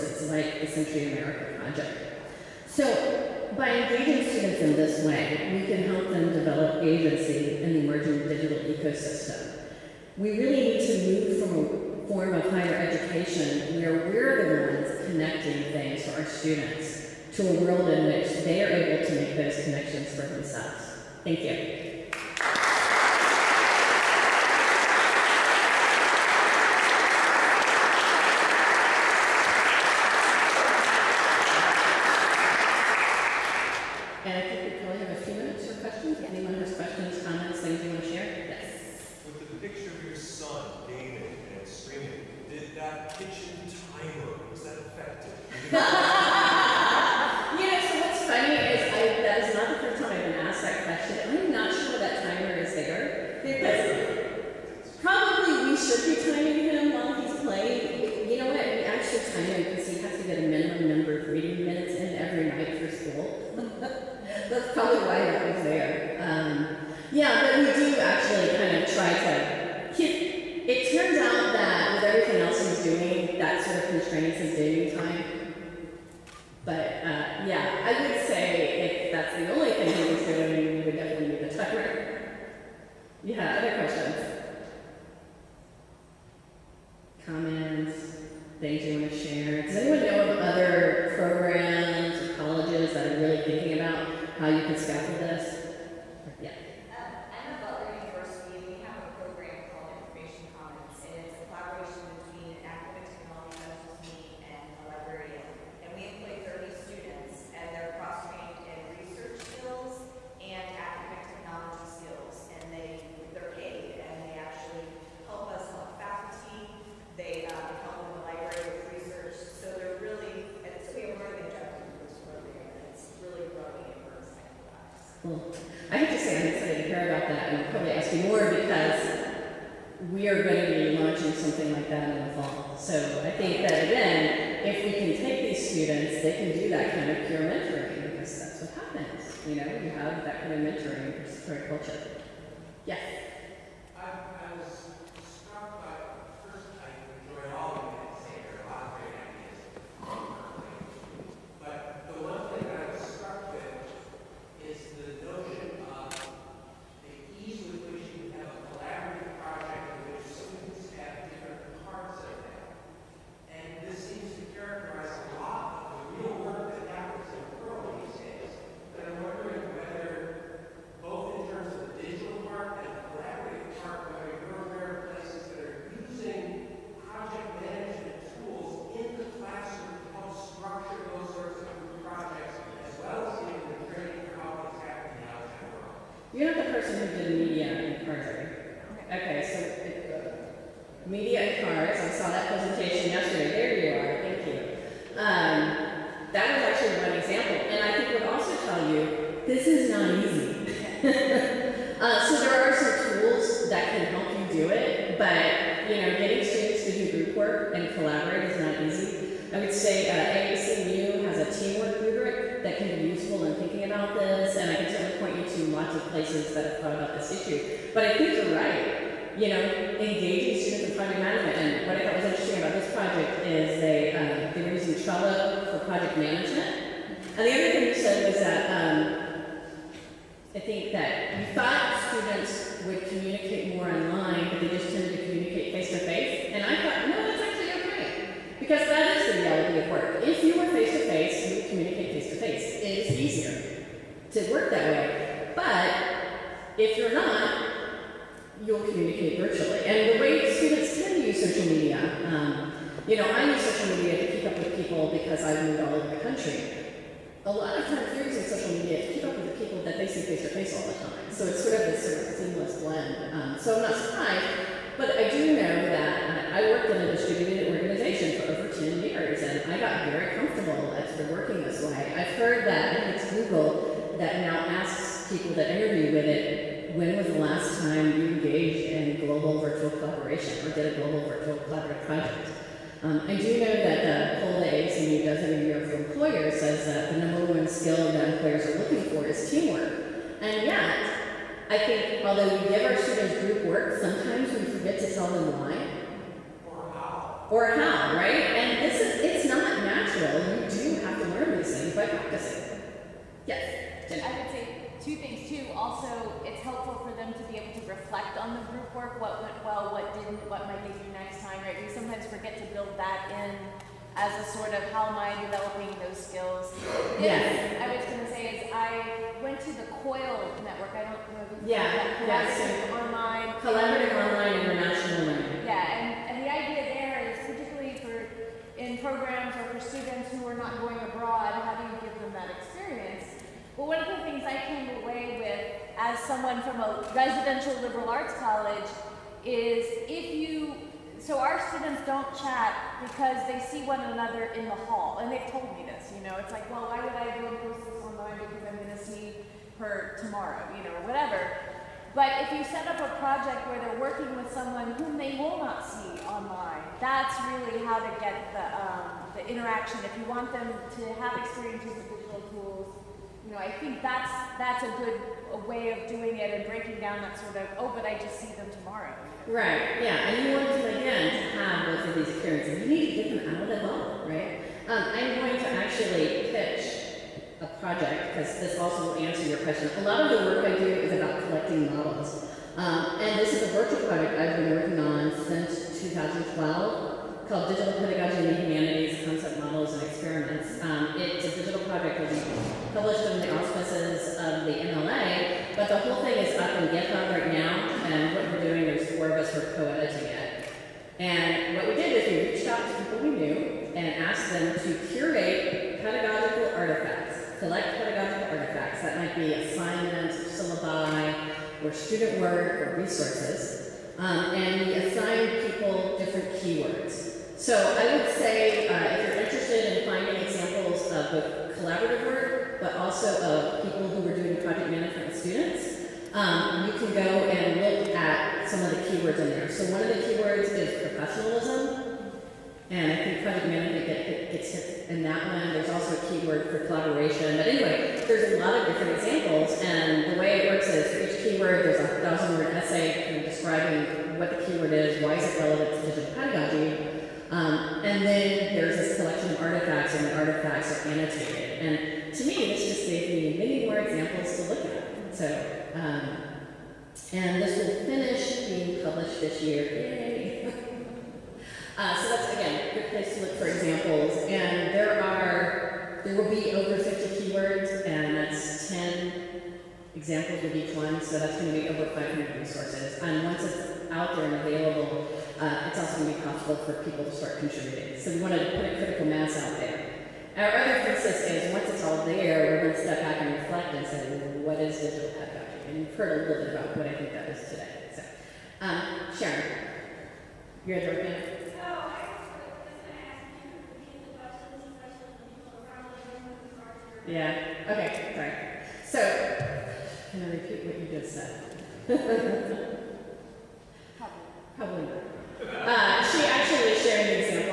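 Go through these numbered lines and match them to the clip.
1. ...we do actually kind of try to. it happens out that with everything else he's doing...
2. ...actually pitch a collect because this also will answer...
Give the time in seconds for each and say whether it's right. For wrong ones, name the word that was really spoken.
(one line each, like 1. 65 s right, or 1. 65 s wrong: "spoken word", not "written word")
1. 67 s wrong: "turns", not "happens"
2. 375 s wrong: "project", not "collect".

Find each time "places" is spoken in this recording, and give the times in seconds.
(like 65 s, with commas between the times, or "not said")
216 s, 463 s.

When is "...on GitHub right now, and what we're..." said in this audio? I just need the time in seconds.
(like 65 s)
396 s.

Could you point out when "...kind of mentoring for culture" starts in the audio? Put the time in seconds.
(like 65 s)
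140 s.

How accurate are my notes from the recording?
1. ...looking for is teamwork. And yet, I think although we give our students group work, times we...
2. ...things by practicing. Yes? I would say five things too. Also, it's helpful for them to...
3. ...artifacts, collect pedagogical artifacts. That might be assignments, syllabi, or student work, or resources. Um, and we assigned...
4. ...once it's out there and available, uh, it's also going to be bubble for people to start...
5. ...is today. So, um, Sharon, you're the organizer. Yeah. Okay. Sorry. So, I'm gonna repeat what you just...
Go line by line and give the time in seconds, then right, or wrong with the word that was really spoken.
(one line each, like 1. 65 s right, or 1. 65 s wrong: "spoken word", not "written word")
1. 288 s wrong: "sometimes", not "times"
2. 301 s wrong: "two", not "five"
3. 406 s right
4. 473 s wrong: "possible", not "bubble"
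5. 487 s right.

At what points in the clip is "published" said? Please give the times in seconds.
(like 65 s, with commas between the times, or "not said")
392 s, 459 s.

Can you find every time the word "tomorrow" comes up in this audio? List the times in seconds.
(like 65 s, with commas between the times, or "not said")
350 s, 368 s.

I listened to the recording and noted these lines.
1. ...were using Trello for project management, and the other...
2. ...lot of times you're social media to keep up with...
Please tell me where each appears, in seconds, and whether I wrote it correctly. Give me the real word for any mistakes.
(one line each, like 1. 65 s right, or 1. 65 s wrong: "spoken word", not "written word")
1. 224 s right
2. 257 s right.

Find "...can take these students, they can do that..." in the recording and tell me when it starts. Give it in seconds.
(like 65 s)
134 s.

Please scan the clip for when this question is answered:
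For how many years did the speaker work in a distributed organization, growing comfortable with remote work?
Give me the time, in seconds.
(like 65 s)
268 s.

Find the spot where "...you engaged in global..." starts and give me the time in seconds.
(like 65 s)
278 s.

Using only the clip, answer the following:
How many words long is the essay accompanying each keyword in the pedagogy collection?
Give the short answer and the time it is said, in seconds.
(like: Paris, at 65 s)
1000, at 442 s.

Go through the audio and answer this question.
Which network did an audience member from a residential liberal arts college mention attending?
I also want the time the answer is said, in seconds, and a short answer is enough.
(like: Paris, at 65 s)
COIL, at 320 s.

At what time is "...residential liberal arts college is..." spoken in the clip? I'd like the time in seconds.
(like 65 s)
337 s.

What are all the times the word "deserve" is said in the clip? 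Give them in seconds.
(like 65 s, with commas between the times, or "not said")
not said.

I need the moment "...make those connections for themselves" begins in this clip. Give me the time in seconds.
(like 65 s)
19 s.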